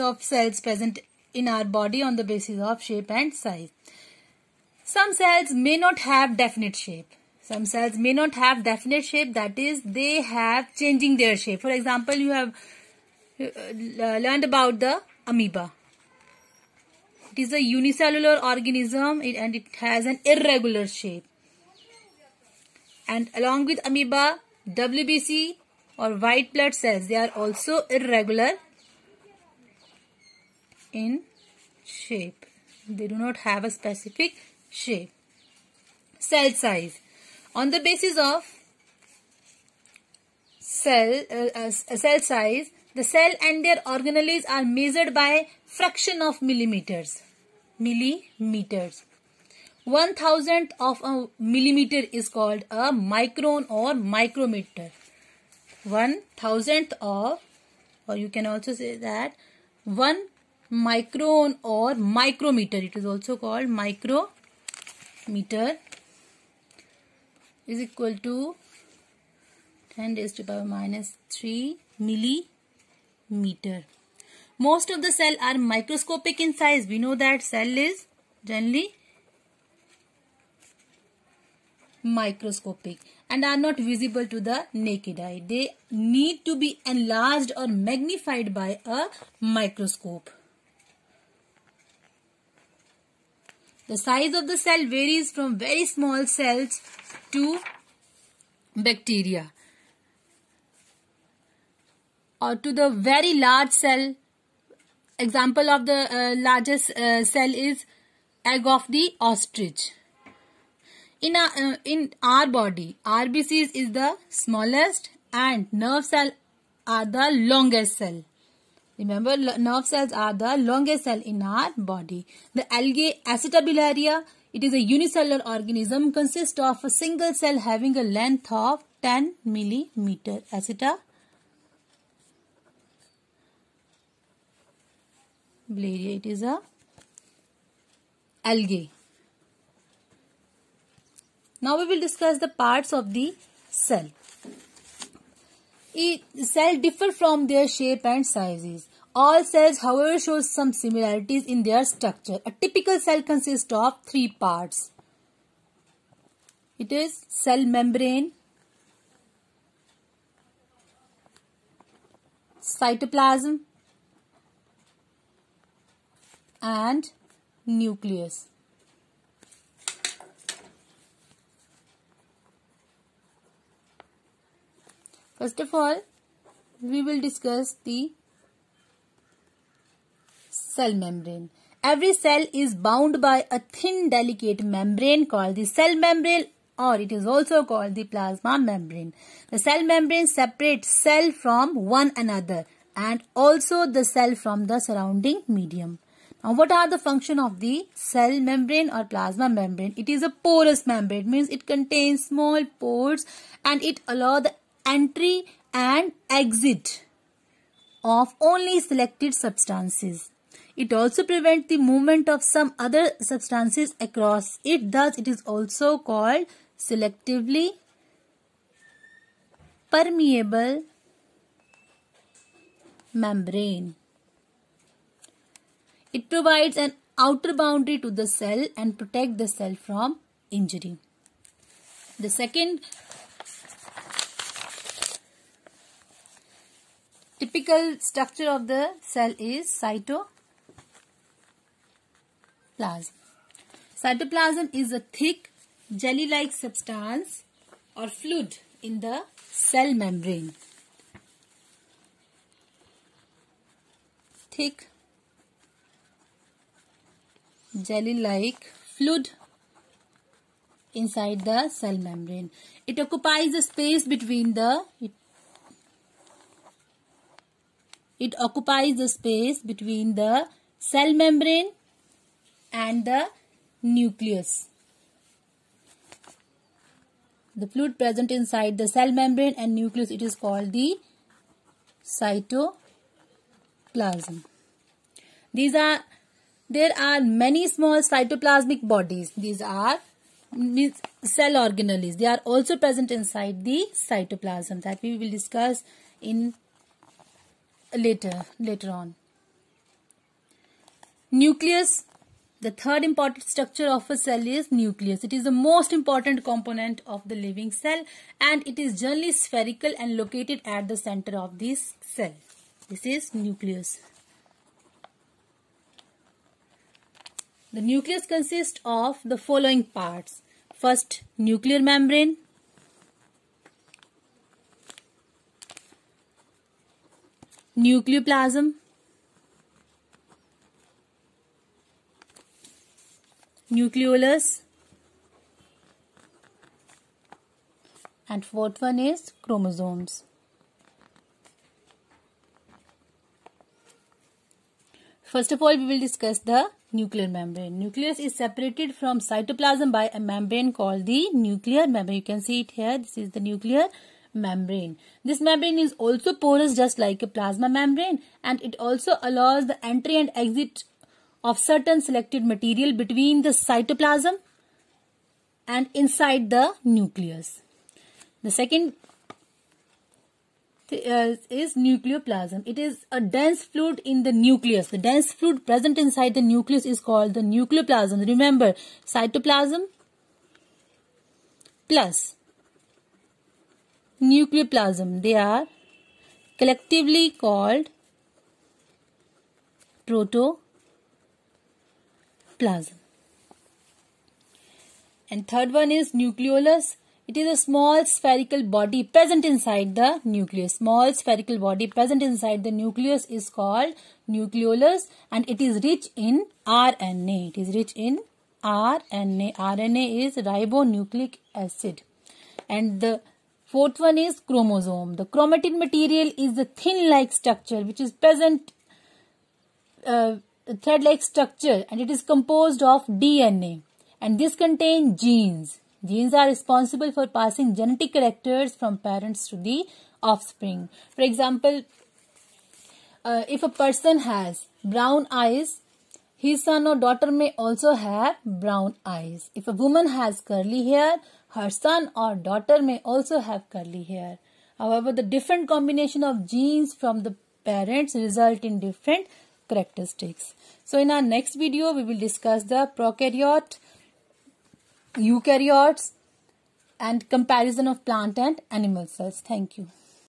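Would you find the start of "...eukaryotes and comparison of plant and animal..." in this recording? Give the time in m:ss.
7:35.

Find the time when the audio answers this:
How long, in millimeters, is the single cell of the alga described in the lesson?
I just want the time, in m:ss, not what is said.
2:09.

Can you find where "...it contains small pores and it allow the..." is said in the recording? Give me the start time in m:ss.
3:21.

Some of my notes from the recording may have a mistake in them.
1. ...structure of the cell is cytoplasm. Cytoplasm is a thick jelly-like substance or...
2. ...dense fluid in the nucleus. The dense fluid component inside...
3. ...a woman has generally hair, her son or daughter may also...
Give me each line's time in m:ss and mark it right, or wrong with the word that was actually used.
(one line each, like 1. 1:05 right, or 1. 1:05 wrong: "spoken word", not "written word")
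1. 3:57 right
2. 6:13 wrong: "present", not "component"
3. 7:19 wrong: "curly", not "generally".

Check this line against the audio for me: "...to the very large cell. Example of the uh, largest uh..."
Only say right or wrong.
right.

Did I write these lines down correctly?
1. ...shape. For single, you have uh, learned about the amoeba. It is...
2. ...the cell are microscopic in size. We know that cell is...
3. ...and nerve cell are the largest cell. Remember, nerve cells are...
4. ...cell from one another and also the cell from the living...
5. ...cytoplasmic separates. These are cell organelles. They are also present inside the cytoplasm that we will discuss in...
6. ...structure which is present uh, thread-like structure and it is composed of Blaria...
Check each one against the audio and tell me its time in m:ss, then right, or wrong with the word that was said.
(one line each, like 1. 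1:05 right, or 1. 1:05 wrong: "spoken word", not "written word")
1. 0:11 wrong: "example", not "single"
2. 1:15 right
3. 1:55 wrong: "longest", not "largest"
4. 3:10 wrong: "surrounding", not "living"
5. 4:48 wrong: "bodies", not "separates"
6. 6:57 wrong: "DNA", not "Blaria".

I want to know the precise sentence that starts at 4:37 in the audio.
The fluid present inside the cell membrane and nucleus it is called the cytoplasm.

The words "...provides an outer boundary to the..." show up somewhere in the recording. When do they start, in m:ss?
3:46.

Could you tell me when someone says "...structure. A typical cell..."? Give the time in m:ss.
2:31.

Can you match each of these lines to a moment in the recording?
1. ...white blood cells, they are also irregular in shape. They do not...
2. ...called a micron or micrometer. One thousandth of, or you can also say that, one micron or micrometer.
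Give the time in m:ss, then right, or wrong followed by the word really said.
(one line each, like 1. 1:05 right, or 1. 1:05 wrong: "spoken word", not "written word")
1. 0:26 right
2. 0:52 right.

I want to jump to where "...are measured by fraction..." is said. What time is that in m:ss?
0:44.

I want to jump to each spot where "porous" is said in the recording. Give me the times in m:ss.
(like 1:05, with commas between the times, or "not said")
3:20, 5:56.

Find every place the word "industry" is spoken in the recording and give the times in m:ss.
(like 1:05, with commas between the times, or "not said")
not said.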